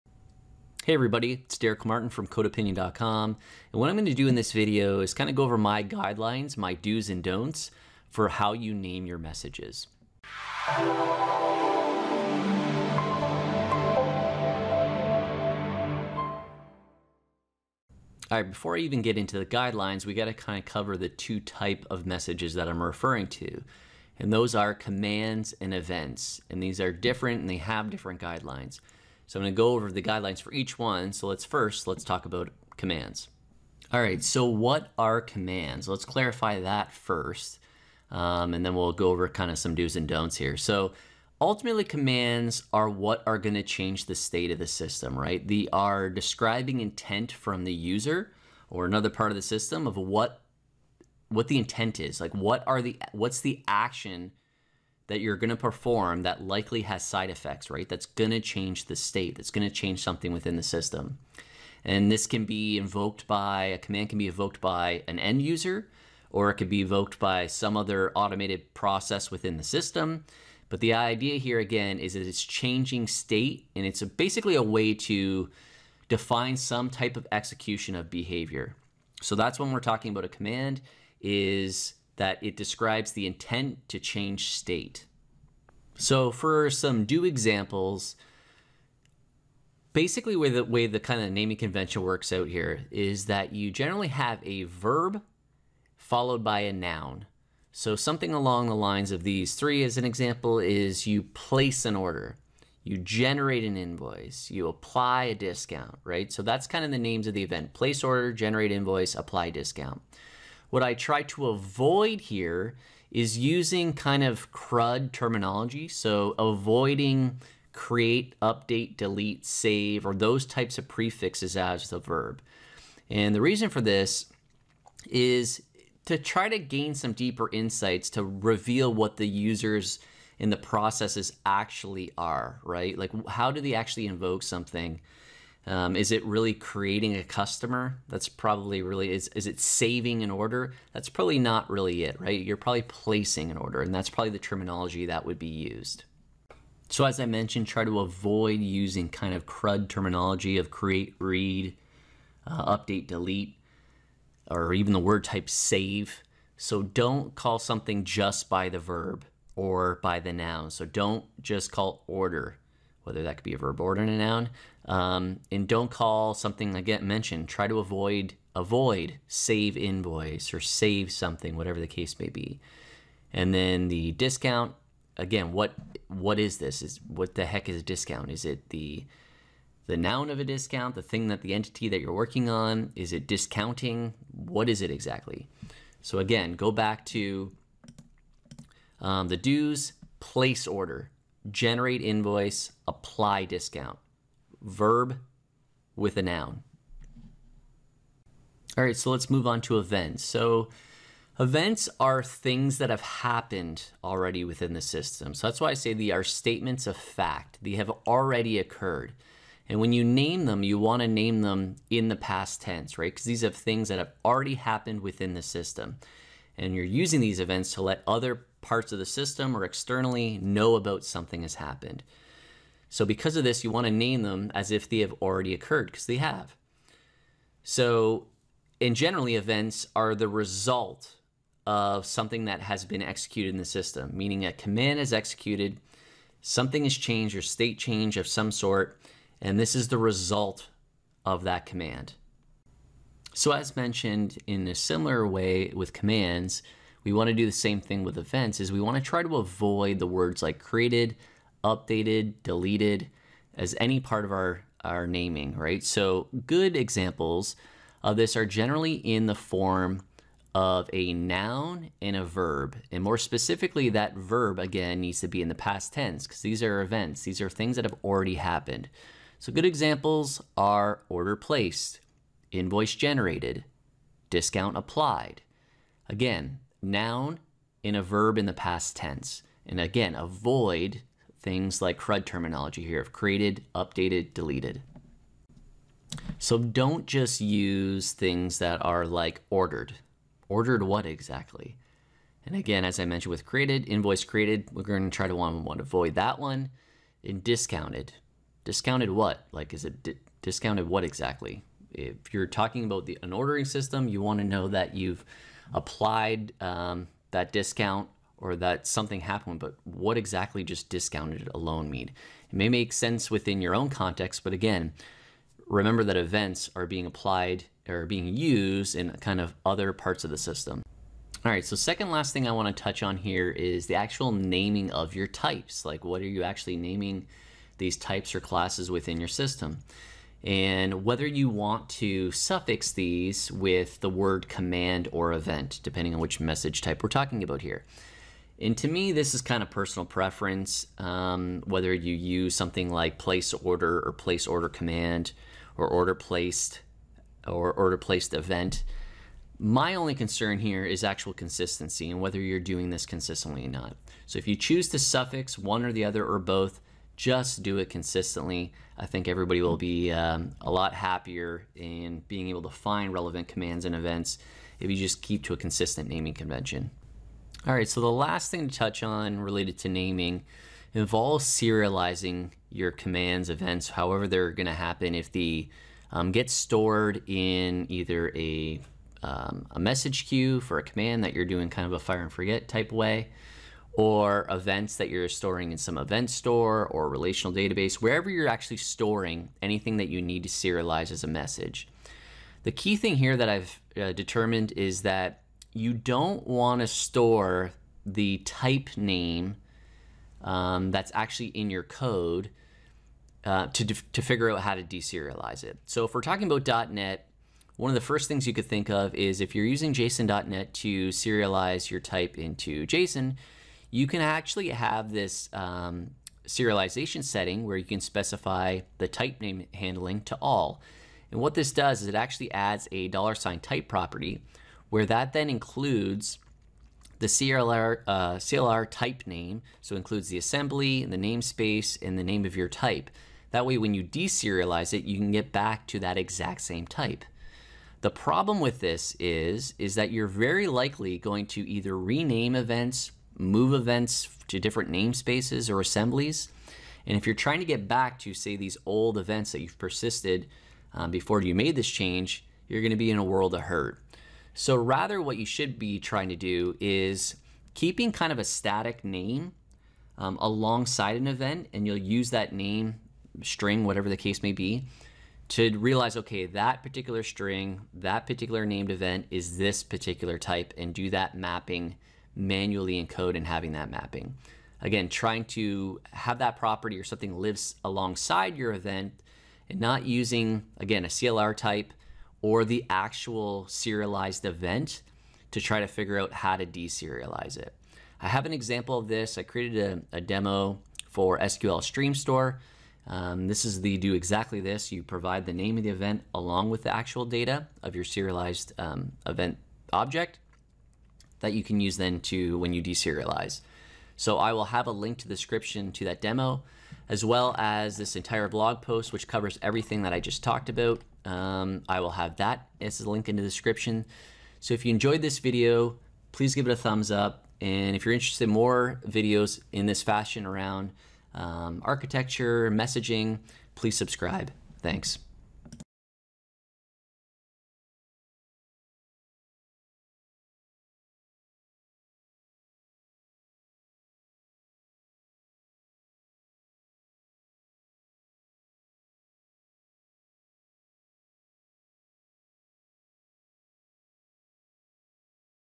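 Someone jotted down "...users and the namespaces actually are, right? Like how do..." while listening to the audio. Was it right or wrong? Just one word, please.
wrong.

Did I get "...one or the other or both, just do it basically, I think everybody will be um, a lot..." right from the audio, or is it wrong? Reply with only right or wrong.
wrong.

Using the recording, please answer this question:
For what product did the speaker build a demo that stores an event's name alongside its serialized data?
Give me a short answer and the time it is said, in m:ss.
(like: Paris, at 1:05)
SQL Stream Store, at 8:11.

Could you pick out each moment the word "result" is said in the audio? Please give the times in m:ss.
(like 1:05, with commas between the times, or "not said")
3:50, 3:59.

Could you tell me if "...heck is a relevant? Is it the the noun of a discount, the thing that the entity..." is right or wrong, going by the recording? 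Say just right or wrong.
wrong.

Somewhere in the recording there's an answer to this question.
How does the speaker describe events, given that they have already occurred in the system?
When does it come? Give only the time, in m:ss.
3:26.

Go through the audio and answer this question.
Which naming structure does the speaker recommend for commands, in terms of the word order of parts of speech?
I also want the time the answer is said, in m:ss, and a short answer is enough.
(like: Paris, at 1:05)
verb followed by a noun, at 1:34.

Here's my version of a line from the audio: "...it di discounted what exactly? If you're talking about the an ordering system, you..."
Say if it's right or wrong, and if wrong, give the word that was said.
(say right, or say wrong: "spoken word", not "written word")
right.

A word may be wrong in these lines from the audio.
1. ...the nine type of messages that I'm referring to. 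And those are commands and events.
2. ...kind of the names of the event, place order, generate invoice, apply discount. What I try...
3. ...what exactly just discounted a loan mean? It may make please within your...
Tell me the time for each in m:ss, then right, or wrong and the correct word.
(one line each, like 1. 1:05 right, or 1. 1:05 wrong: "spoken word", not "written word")
1. 0:20 wrong: "two", not "nine"
2. 1:46 right
3. 5:09 wrong: "sense", not "please".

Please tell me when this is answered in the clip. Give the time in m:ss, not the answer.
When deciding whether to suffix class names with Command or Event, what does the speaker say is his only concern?
5:51.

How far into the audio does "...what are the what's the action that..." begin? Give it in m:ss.
0:52.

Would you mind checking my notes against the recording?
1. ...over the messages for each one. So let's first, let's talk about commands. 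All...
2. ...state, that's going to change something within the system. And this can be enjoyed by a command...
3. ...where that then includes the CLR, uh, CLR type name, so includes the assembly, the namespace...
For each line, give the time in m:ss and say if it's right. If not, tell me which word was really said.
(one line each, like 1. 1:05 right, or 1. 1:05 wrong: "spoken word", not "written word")
1. 0:29 wrong: "guidelines", not "messages"
2. 0:58 wrong: "invoked", not "enjoyed"
3. 7:04 right.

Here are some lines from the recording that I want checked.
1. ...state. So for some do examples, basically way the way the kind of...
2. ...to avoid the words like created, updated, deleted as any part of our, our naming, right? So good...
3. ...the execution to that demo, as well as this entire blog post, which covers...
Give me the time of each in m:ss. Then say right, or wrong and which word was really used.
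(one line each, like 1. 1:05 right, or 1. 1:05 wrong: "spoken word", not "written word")
1. 1:24 right
2. 4:09 right
3. 8:25 wrong: "description", not "execution".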